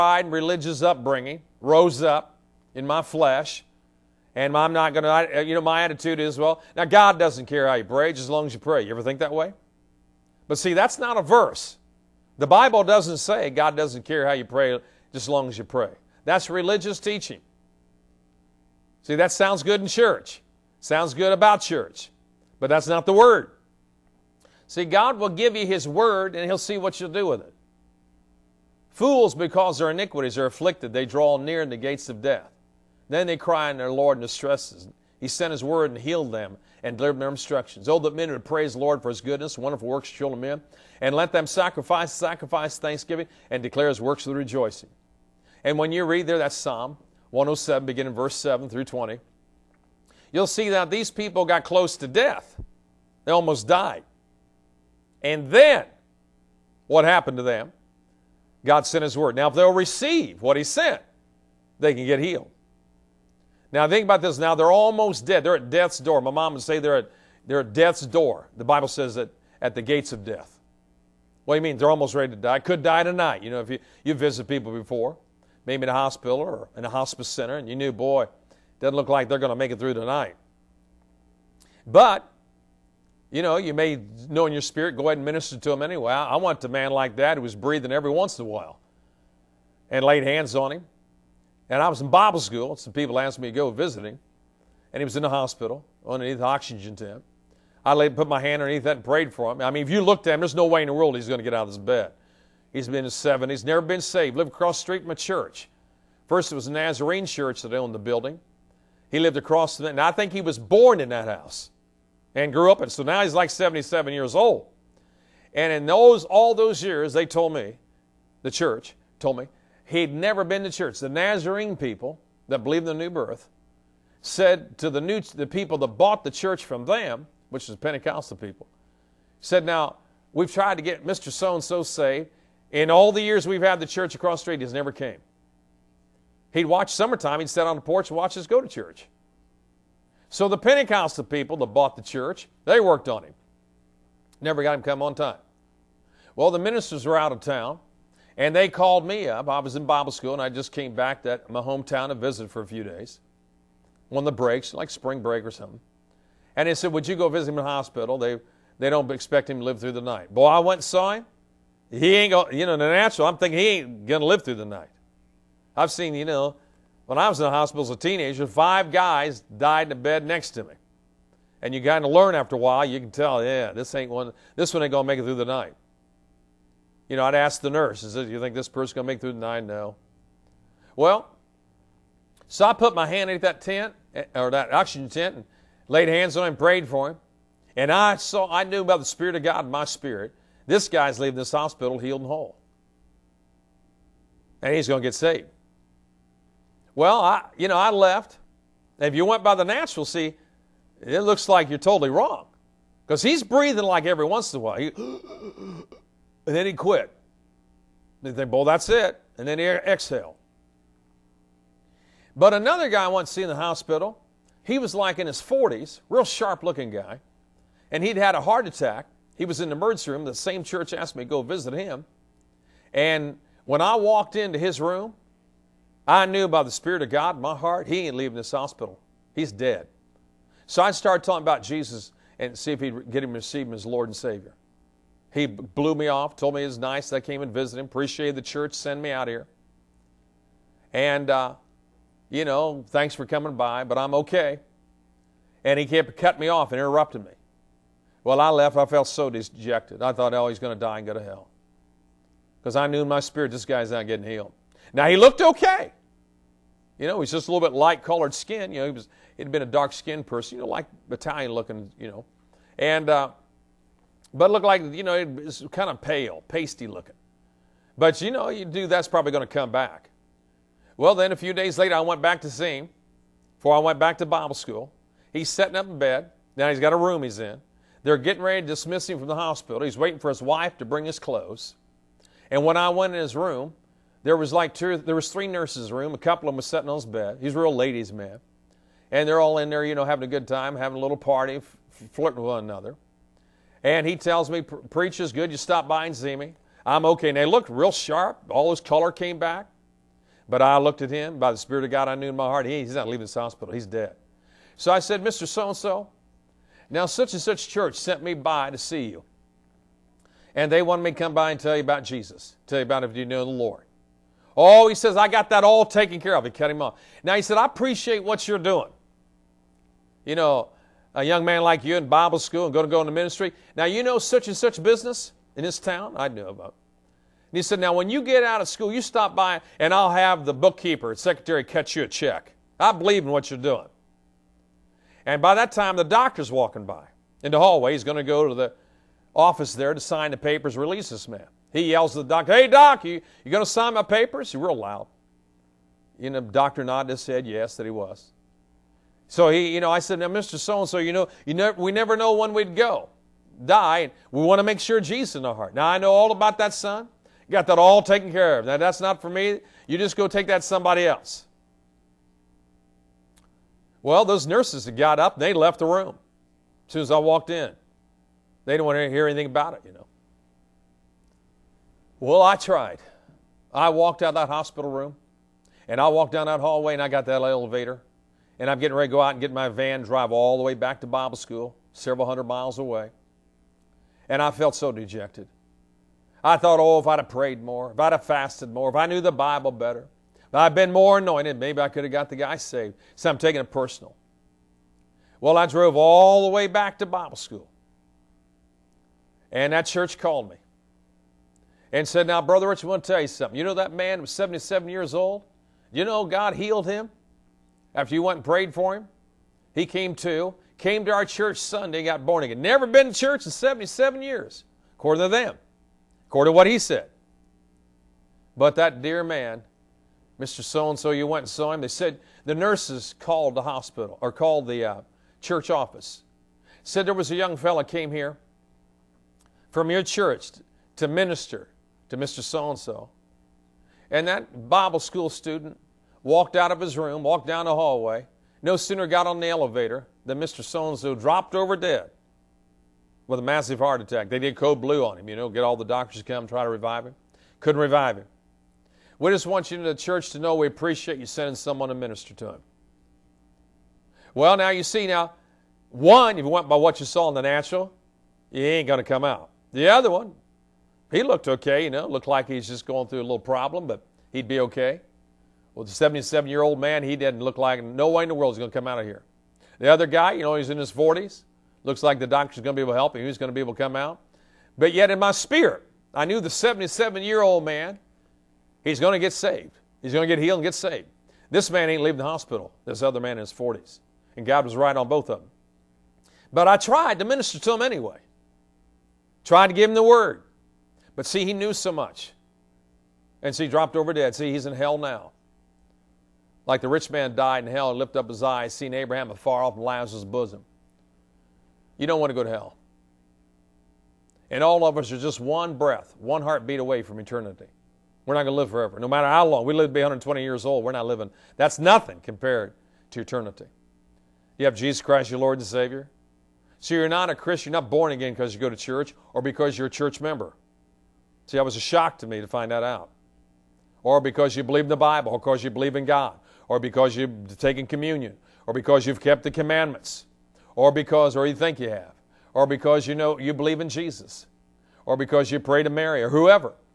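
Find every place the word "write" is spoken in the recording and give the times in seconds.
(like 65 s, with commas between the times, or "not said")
not said.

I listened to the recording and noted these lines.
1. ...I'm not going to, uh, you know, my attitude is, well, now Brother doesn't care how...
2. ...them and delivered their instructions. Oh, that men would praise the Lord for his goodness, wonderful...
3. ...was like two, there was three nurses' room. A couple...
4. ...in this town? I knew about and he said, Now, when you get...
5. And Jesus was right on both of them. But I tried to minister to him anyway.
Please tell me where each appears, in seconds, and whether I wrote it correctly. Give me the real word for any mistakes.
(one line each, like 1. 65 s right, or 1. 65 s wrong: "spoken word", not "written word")
1. 4 s wrong: "God", not "Brother"
2. 36 s right
3. 284 s right
4. 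325 s right
5. 484 s wrong: "God", not "Jesus".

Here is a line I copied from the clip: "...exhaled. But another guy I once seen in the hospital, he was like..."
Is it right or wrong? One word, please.
right.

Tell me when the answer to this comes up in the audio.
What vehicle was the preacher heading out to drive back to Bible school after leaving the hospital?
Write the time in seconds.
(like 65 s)
379 s.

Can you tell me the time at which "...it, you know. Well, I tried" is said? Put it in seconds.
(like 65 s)
369 s.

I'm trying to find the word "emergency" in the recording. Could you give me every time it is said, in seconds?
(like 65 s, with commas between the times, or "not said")
219 s.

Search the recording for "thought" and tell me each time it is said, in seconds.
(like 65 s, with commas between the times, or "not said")
250 s, 386 s.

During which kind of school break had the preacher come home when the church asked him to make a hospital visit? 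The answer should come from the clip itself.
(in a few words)
Spring break.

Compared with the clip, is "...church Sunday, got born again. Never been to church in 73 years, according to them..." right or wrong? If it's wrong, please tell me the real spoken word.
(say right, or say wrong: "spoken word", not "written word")
wrong: "77", not "73".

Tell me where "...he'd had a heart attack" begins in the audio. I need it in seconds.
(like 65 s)
218 s.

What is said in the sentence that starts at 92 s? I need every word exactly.
Some people asked me to go visit him.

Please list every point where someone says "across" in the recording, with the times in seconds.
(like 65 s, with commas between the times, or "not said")
104 s, 109 s, 134 s.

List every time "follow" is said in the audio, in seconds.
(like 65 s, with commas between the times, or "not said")
not said.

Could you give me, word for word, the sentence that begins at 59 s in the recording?
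Now, if they'll receive what He sent, they can get healed.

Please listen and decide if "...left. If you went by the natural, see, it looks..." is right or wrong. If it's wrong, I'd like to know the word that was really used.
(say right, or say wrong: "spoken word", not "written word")
right.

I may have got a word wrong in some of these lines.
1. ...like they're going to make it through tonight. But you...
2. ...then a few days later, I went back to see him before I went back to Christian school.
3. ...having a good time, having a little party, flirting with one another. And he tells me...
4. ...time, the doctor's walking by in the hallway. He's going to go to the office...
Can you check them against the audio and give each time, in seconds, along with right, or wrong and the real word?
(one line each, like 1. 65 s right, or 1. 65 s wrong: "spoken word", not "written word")
1. 79 s right
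2. 271 s wrong: "Bible", not "Christian"
3. 290 s right
4. 335 s right.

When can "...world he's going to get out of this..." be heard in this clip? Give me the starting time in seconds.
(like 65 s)
100 s.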